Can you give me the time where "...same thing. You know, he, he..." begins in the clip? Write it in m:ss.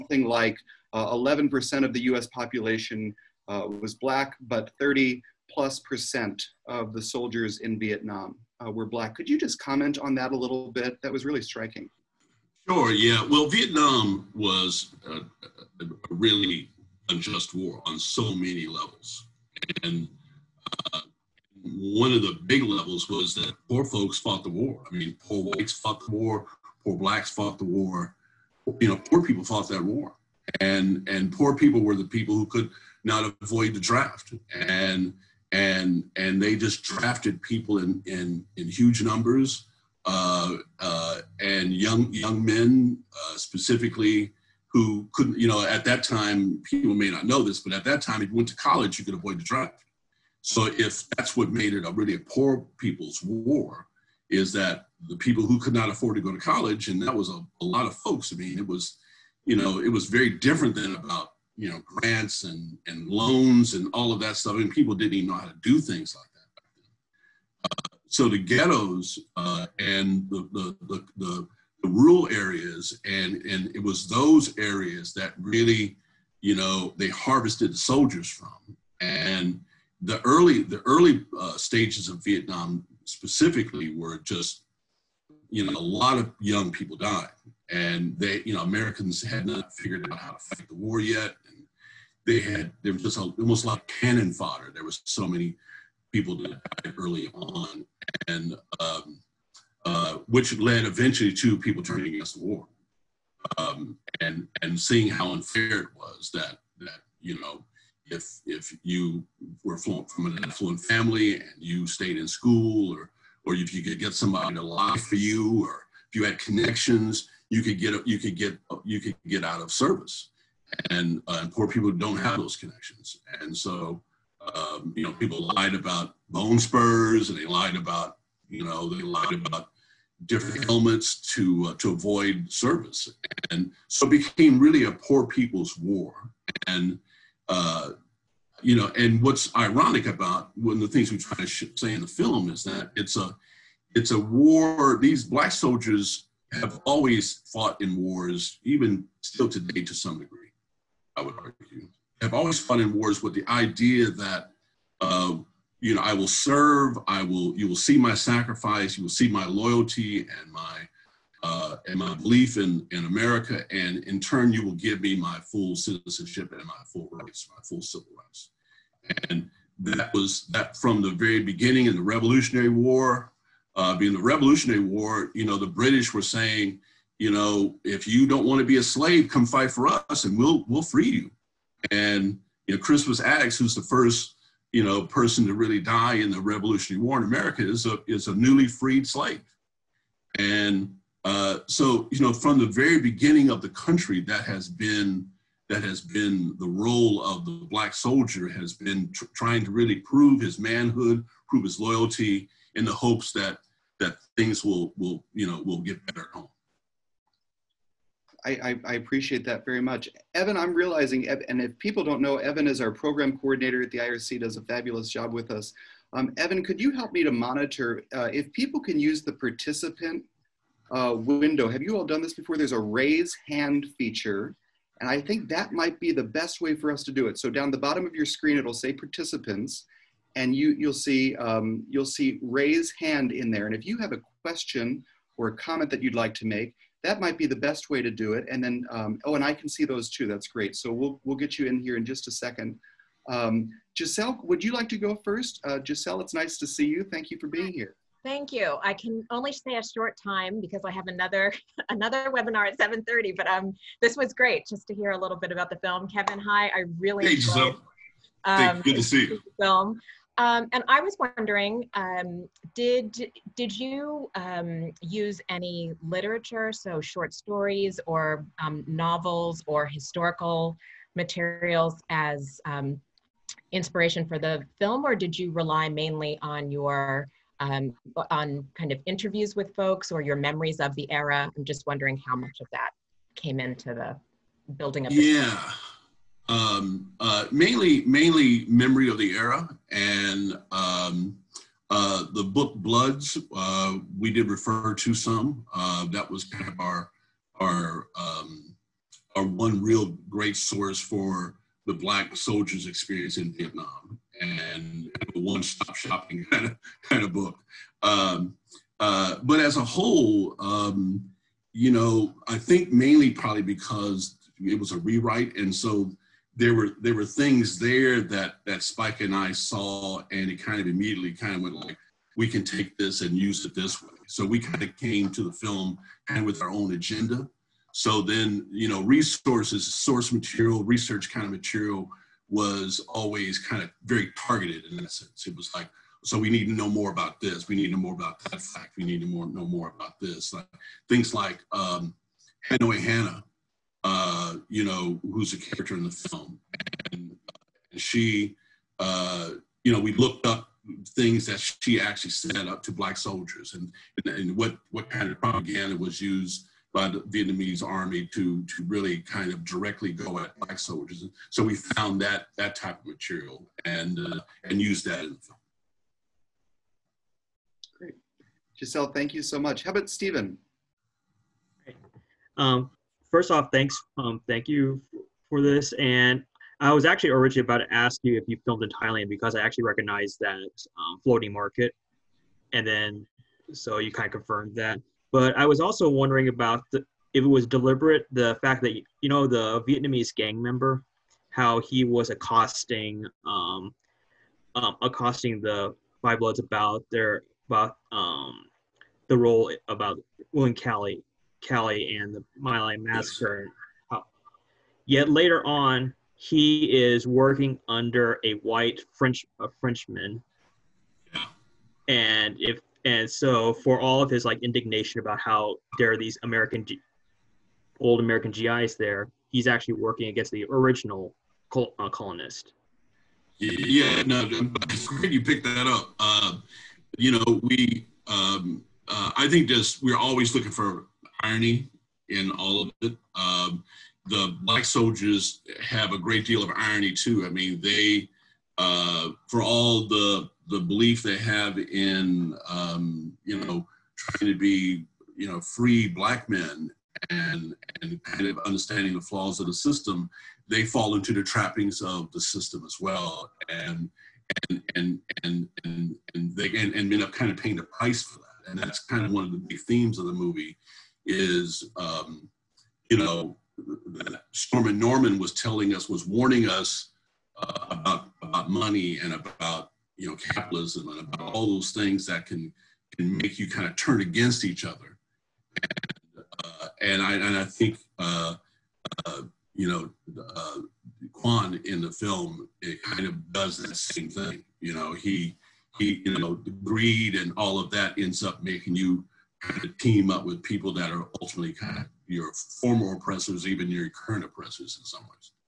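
8:03.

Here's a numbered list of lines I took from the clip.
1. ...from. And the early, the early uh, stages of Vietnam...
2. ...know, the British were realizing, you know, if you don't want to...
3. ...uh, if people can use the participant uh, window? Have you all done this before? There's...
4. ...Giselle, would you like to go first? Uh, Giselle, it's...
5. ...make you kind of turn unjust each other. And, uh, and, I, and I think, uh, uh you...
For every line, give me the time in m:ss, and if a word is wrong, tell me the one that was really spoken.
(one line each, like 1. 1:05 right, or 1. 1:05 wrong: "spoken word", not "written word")
1. 1:18 right
2. 2:55 wrong: "saying", not "realizing"
3. 3:38 right
4. 4:03 right
5. 7:53 wrong: "against", not "unjust".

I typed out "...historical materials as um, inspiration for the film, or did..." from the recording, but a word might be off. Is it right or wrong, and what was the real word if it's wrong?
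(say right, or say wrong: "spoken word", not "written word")
right.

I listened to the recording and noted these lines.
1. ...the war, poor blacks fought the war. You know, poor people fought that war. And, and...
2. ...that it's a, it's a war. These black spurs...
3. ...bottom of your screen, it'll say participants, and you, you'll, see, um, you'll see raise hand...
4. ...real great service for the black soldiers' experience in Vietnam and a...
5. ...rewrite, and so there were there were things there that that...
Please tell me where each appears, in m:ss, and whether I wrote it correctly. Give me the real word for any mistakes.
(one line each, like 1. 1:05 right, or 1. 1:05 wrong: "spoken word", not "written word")
1. 0:26 right
2. 2:22 wrong: "soldiers", not "spurs"
3. 3:47 right
4. 4:59 wrong: "source", not "service"
5. 5:14 right.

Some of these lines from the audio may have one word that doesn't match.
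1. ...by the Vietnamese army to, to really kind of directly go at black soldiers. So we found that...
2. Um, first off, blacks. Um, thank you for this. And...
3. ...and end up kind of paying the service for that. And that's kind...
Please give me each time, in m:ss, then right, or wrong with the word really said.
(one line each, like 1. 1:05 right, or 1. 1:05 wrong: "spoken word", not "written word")
1. 5:56 right
2. 6:12 wrong: "thanks", not "blacks"
3. 7:36 wrong: "price", not "service".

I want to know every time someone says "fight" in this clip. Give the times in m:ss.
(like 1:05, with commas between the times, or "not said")
1:30, 2:59.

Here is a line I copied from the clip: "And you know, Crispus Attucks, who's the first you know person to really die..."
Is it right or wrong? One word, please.
right.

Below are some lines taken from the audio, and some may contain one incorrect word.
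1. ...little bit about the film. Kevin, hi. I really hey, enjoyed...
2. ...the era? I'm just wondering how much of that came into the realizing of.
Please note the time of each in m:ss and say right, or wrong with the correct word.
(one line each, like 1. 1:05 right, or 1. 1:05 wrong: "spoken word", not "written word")
1. 4:15 right
2. 4:40 wrong: "building", not "realizing".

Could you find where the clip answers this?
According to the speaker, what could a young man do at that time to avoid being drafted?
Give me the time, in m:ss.
0:48.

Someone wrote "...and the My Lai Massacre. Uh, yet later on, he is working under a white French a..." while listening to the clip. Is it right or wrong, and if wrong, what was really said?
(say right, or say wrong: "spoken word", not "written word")
right.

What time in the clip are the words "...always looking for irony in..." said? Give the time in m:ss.
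7:10.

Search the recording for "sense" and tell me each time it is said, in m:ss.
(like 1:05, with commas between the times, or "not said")
5:35.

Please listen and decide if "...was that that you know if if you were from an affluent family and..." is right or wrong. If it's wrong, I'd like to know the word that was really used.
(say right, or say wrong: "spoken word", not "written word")
right.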